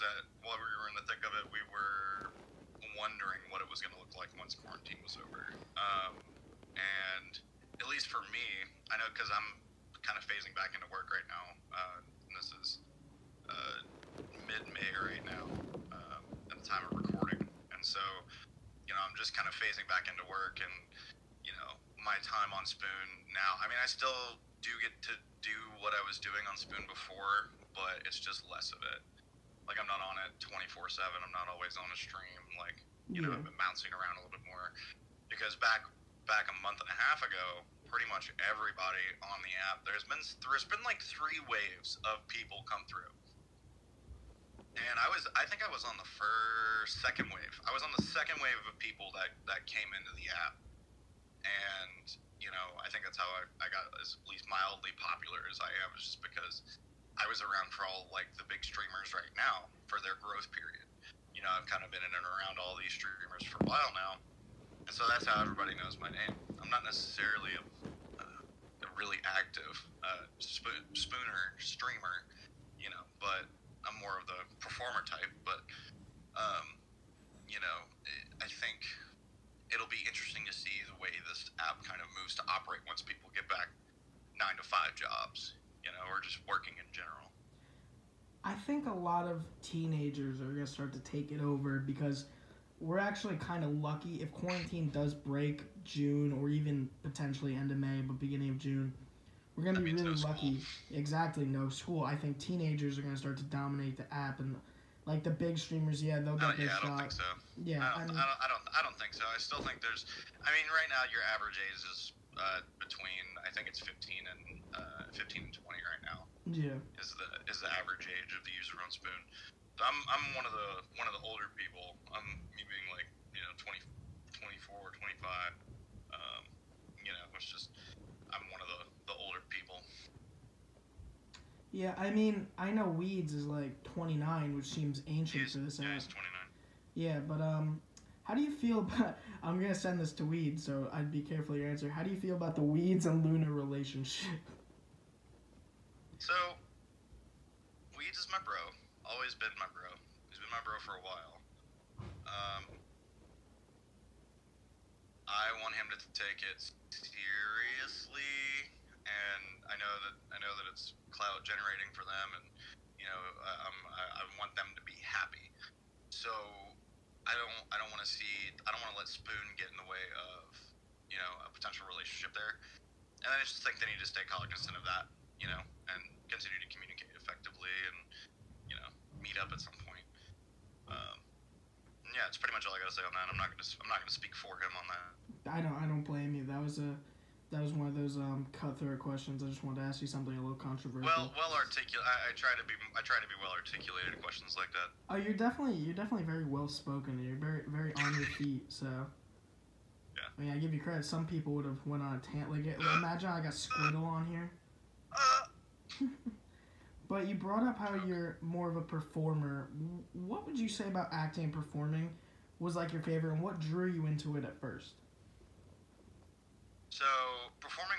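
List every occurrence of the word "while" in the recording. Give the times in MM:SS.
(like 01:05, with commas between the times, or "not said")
00:00, 01:03, 02:31.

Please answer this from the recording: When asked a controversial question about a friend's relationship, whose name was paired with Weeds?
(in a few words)
Luna.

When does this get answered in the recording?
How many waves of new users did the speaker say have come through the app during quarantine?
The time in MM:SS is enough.
00:41.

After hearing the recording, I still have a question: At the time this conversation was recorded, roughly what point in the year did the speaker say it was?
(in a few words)
mid-May.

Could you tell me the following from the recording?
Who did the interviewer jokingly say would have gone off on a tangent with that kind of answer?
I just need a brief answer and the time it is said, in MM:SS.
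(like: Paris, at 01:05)
Squirtle, at 03:23.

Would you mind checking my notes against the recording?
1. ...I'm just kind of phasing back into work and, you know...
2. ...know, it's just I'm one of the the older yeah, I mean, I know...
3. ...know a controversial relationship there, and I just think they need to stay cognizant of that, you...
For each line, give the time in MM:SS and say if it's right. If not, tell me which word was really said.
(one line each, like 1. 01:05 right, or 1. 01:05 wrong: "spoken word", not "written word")
1. 00:19 right
2. 02:07 right
3. 02:51 wrong: "potential", not "controversial".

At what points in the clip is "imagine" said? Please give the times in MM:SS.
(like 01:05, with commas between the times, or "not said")
03:22.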